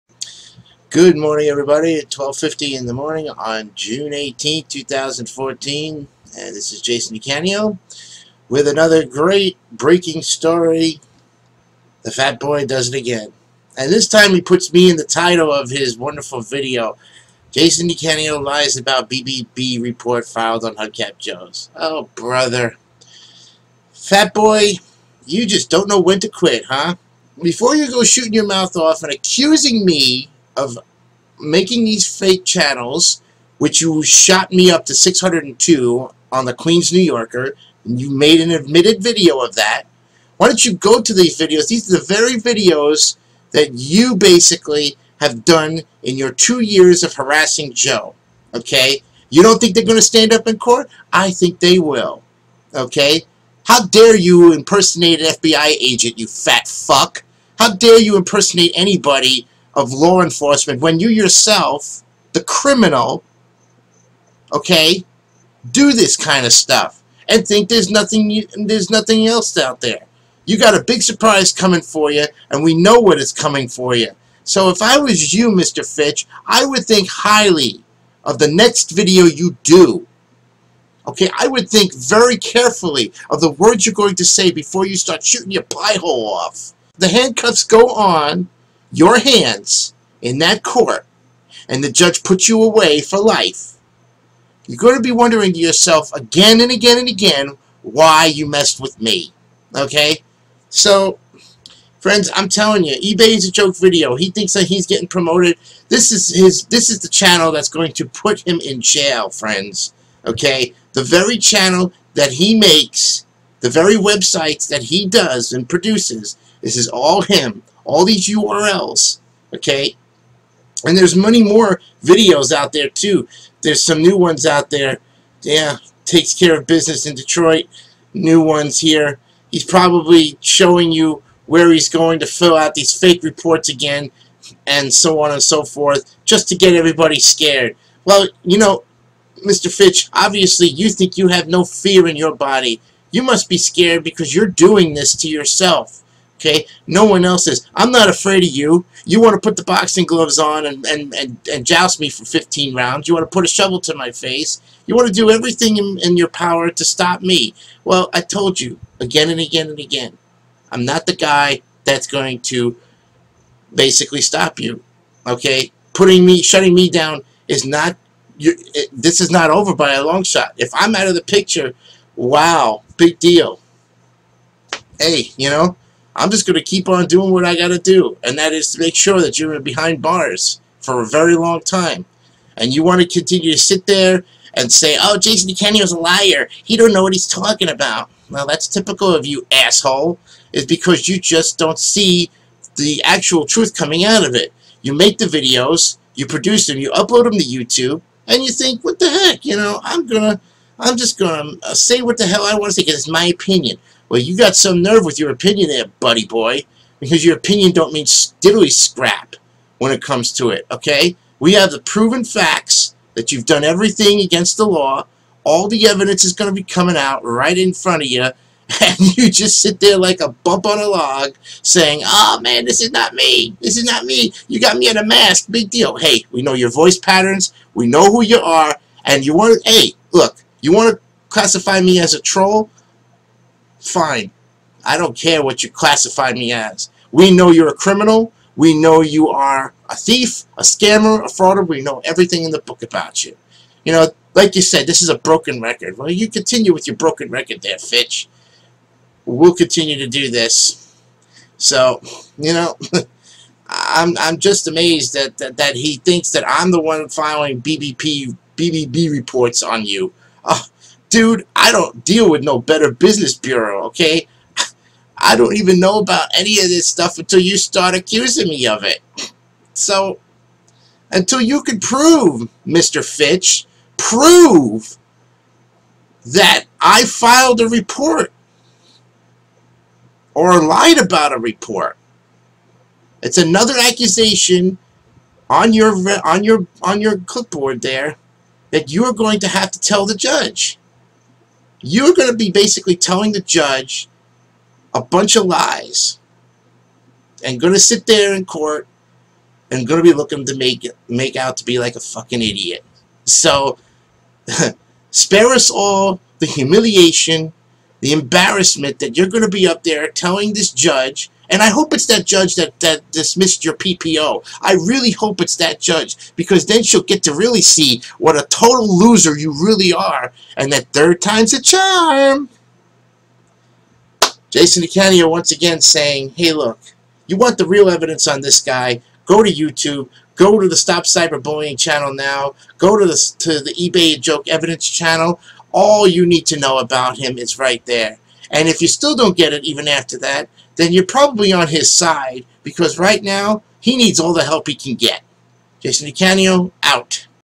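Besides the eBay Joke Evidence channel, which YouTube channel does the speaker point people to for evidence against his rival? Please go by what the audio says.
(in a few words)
Stop Cyberbullying.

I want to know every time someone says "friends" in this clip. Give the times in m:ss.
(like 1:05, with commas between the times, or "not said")
1:41, 1:49.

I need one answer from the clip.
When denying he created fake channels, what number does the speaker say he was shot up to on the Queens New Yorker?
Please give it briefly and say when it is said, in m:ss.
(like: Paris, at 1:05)
602, at 0:34.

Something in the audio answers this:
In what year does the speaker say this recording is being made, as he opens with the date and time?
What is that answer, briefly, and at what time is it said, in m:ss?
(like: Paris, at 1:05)
2014, at 0:04.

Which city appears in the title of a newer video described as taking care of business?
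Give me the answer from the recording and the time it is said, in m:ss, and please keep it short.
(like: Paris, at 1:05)
Detroit, at 2:07.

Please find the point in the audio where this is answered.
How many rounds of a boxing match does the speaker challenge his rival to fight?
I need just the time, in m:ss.
2:32.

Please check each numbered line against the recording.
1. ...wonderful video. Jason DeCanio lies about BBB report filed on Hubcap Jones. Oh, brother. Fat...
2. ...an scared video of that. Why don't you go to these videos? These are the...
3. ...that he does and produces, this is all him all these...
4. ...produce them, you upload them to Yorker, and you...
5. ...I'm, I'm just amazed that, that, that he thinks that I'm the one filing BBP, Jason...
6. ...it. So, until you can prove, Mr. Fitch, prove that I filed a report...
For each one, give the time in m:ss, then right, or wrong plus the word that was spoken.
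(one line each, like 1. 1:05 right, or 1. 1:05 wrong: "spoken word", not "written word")
1. 0:15 right
2. 0:38 wrong: "admitted", not "scared"
3. 1:54 right
4. 3:16 wrong: "YouTube", not "Yorker"
5. 4:13 wrong: "BBB", not "Jason"
6. 4:28 right.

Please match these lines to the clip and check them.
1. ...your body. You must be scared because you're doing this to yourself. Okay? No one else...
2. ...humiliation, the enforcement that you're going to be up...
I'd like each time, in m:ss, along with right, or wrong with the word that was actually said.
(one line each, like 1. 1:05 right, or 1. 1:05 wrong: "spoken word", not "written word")
1. 2:22 right
2. 5:06 wrong: "embarrassment", not "enforcement".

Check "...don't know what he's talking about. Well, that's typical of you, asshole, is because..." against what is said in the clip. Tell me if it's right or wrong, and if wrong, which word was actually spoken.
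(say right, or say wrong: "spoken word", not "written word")
right.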